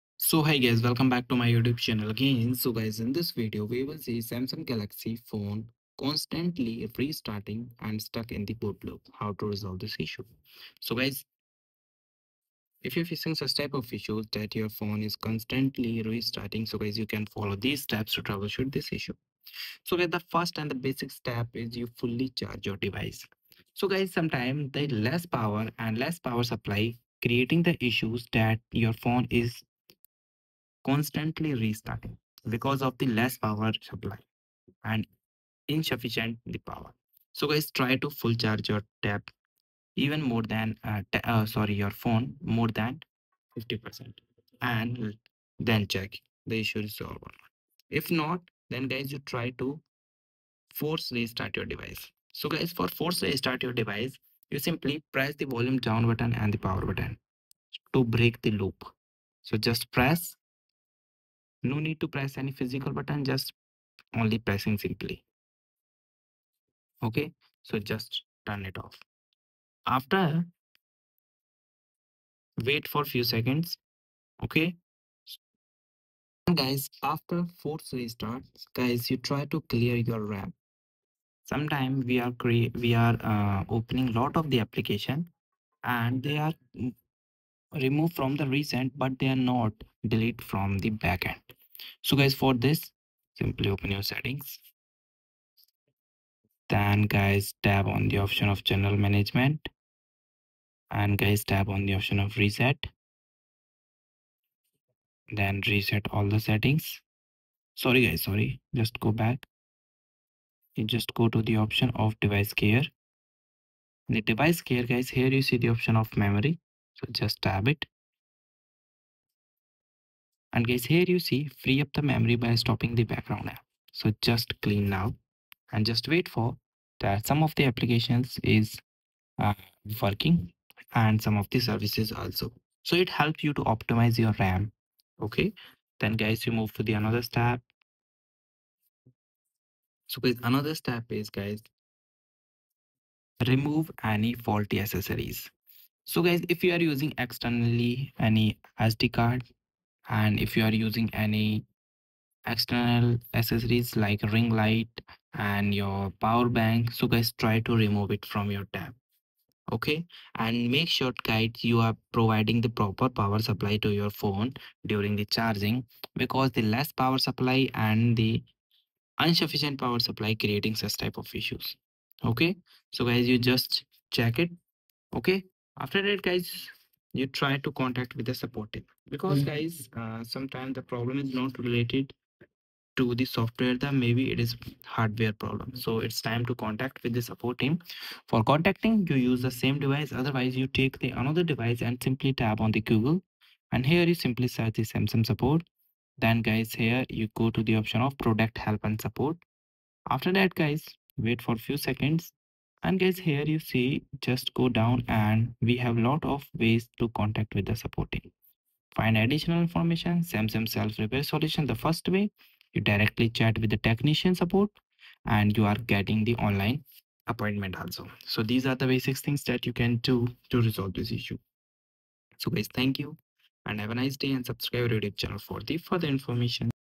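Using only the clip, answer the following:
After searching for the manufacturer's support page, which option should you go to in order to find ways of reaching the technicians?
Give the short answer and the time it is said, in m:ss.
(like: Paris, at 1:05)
Product help and support, at 3:18.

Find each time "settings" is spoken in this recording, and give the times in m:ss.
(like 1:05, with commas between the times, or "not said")
1:34, 1:46.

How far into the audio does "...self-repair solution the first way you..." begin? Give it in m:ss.
3:30.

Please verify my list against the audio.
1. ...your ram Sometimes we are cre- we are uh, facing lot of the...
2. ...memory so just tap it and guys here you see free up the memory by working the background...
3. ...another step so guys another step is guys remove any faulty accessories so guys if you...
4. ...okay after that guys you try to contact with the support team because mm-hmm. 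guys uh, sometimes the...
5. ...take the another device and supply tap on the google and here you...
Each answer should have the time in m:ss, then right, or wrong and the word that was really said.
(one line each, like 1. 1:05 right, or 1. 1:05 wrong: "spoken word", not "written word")
1. 1:19 wrong: "opening", not "facing"
2. 1:56 wrong: "stopping", not "working"
3. 2:16 right
4. 2:55 right
5. 3:10 wrong: "simply", not "supply".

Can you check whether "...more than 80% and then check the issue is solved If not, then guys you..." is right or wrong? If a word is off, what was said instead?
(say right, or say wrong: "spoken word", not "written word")
wrong: "50", not "80".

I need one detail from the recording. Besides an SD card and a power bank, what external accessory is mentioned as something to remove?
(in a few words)
Ring light.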